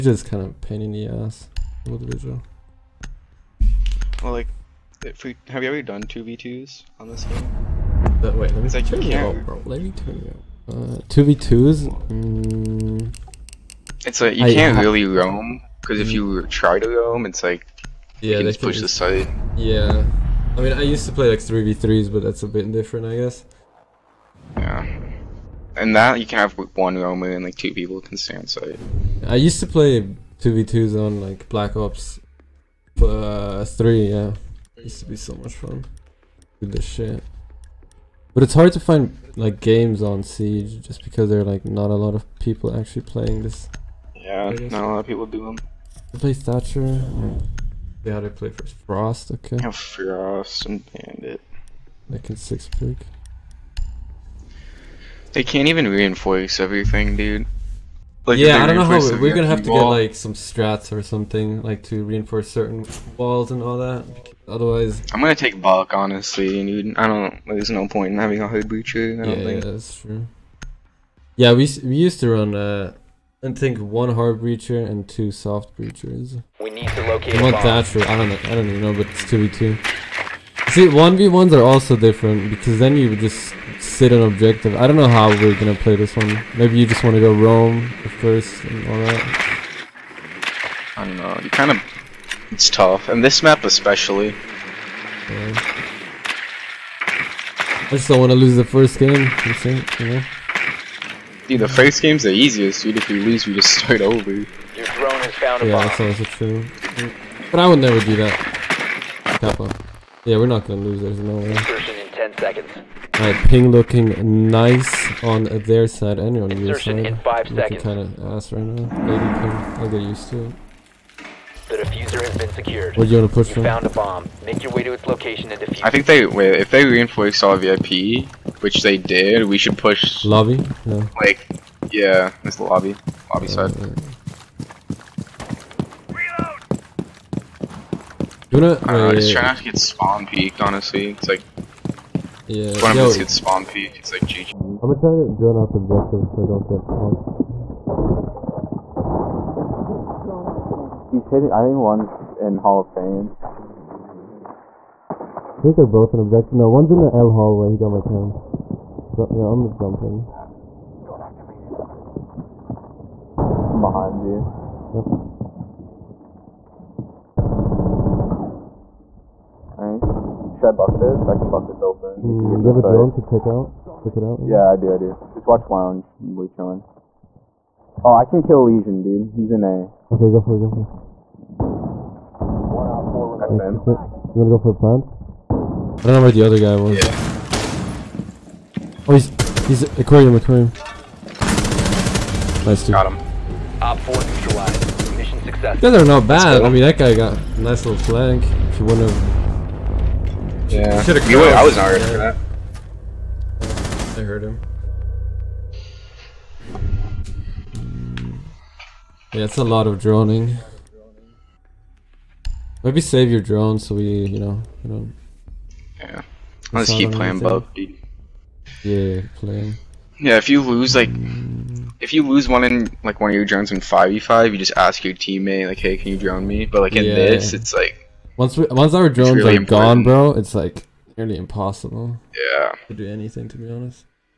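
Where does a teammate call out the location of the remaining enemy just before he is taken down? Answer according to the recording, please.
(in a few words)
Aquarium.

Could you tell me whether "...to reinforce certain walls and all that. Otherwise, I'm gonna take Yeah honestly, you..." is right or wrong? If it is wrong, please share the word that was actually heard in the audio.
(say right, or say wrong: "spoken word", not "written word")
wrong: "Buck", not "Yeah".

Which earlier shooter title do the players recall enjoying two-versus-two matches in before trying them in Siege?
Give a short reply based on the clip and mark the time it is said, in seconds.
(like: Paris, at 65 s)
Black Ops 3, at 31 s.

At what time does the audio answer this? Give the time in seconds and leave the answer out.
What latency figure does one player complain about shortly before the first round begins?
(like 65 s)
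119 s.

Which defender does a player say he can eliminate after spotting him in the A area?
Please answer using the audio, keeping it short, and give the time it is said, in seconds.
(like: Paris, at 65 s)
Lesion, at 178 s.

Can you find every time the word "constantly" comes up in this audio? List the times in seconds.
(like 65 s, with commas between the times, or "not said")
not said.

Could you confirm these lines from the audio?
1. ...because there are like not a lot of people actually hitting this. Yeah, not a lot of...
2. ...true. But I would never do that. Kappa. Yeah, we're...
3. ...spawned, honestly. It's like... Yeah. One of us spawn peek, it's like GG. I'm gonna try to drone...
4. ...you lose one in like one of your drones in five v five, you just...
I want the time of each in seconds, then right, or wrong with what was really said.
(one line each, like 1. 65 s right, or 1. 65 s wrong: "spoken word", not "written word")
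1. 41 s wrong: "playing", not "hitting"
2. 106 s right
3. 140 s wrong: "peeked", not "spawned"
4. 222 s right.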